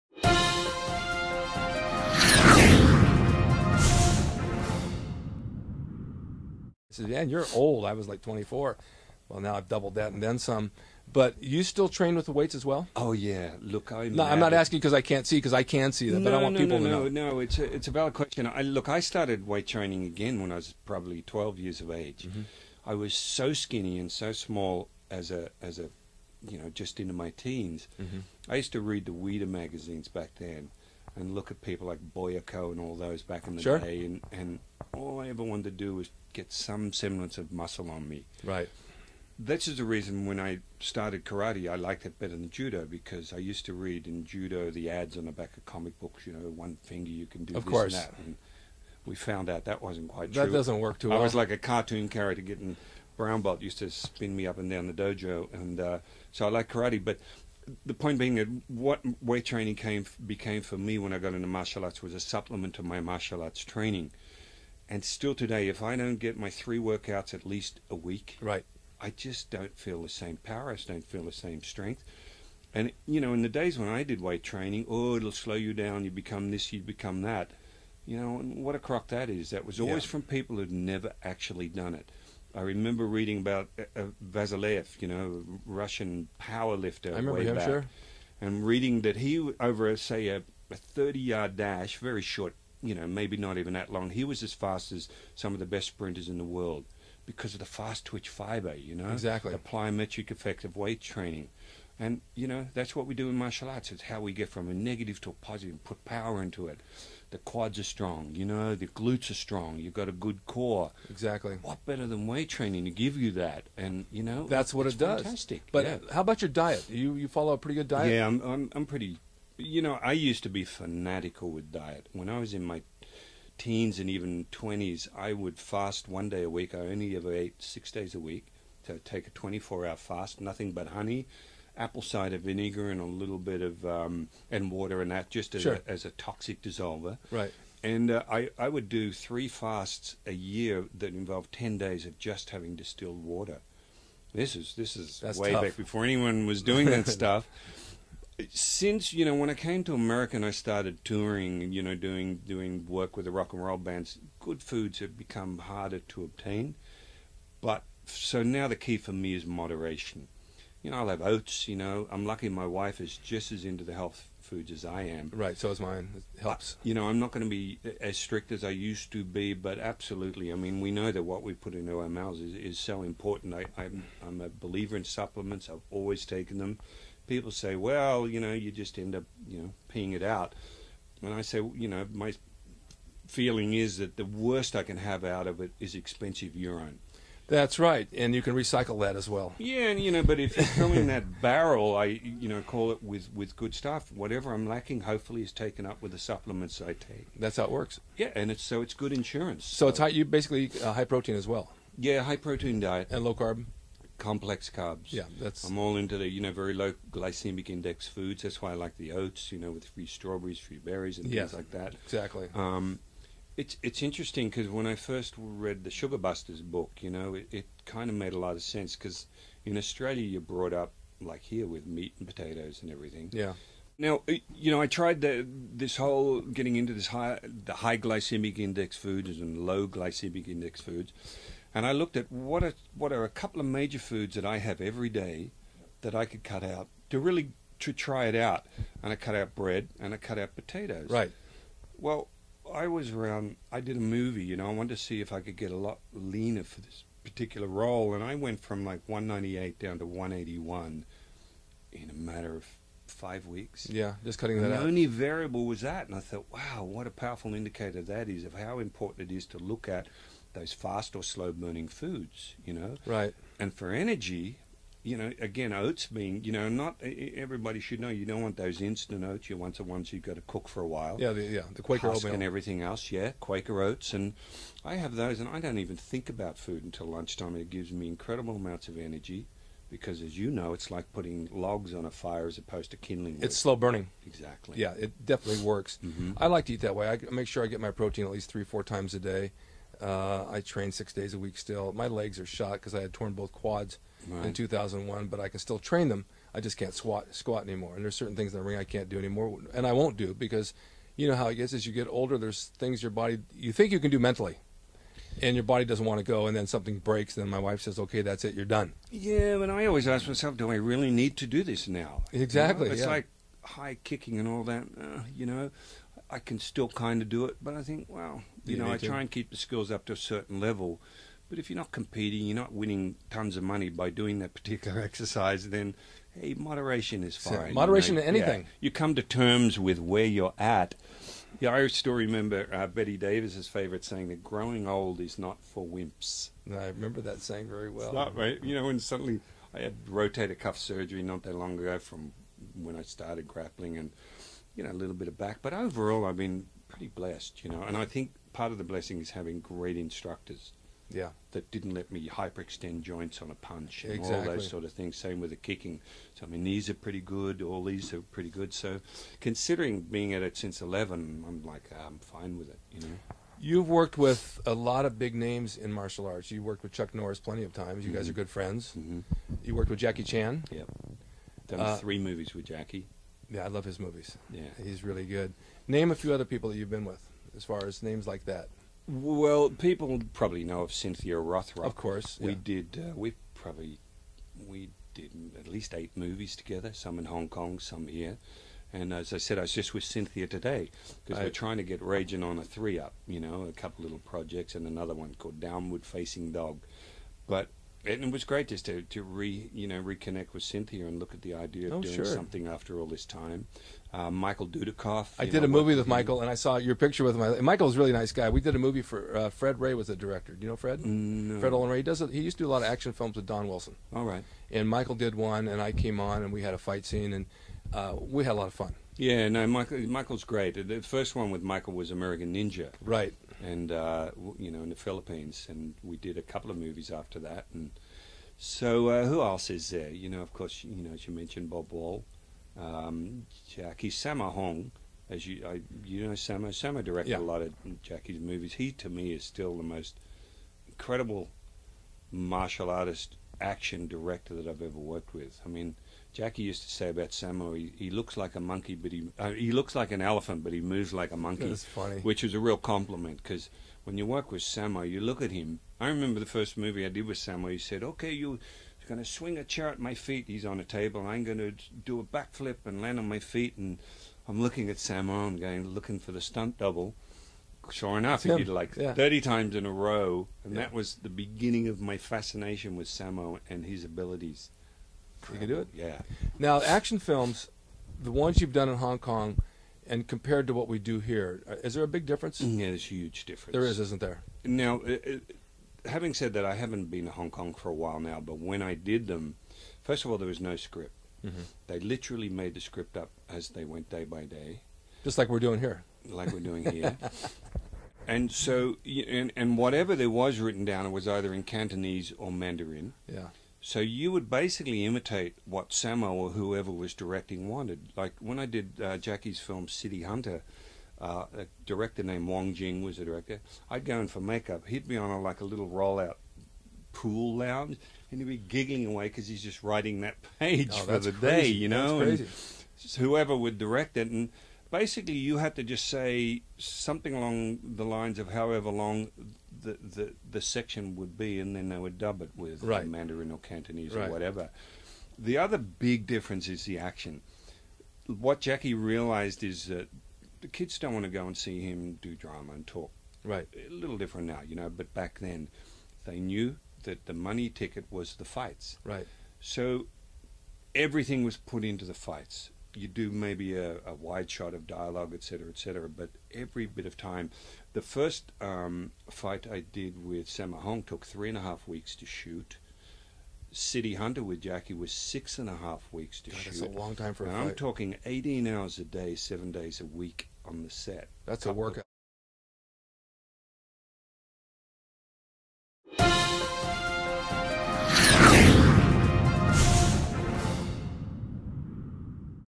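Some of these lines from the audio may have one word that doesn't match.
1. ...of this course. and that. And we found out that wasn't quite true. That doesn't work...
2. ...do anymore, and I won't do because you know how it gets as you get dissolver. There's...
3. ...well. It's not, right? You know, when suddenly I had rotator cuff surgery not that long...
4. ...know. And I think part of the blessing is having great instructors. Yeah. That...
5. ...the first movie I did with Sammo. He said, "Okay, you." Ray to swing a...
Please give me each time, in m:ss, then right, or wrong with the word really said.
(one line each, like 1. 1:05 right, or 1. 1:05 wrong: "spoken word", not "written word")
1. 0:47 right
2. 4:59 wrong: "older", not "dissolver"
3. 5:37 right
4. 5:47 right
5. 7:36 wrong: "Going", not "Ray".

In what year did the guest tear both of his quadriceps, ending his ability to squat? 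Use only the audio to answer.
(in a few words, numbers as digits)
2001.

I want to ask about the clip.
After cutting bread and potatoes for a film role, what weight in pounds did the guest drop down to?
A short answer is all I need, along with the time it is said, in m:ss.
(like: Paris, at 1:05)
181, at 4:10.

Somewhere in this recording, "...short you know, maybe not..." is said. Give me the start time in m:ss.
1:32.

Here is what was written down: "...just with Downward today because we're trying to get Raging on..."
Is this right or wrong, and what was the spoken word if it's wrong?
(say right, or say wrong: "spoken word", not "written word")
wrong: "Cynthia", not "Downward".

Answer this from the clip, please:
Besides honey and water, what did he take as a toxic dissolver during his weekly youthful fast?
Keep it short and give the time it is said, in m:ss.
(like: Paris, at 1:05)
apple cider vinegar, at 2:11.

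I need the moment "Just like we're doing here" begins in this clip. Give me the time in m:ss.
8:15.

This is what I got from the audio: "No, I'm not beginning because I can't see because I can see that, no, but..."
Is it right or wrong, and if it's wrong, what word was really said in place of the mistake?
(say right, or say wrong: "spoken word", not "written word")
wrong: "asking", not "beginning".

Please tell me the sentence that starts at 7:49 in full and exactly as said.
30 times in a row, and yeah.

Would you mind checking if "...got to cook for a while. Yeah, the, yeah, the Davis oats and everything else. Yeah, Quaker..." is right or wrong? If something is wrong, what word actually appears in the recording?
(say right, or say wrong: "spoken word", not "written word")
wrong: "Quaker", not "Davis".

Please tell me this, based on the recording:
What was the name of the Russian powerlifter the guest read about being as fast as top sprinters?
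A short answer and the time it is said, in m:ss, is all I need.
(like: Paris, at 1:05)
Vasilev, at 1:24.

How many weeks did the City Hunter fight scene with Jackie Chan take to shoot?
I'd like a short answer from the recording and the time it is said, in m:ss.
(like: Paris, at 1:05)
6.5 weeks, at 9:25.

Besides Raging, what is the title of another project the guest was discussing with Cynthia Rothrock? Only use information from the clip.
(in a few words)
Downward Facing Dog.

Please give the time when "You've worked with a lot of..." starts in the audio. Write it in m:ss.
6:03.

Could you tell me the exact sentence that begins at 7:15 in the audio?
As you, I, you know, Sammo Sammo directed yeah.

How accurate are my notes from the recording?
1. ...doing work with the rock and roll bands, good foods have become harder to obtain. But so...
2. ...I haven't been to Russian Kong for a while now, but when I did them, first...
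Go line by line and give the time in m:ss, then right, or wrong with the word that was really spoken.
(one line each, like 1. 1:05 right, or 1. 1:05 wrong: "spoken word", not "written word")
1. 2:32 right
2. 8:06 wrong: "Hong", not "Russian".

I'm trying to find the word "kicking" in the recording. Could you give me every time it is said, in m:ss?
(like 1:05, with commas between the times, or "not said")
5:14, 5:55.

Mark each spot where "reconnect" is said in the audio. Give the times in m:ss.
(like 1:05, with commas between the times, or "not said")
6:40.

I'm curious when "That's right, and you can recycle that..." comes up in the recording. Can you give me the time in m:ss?
3:07.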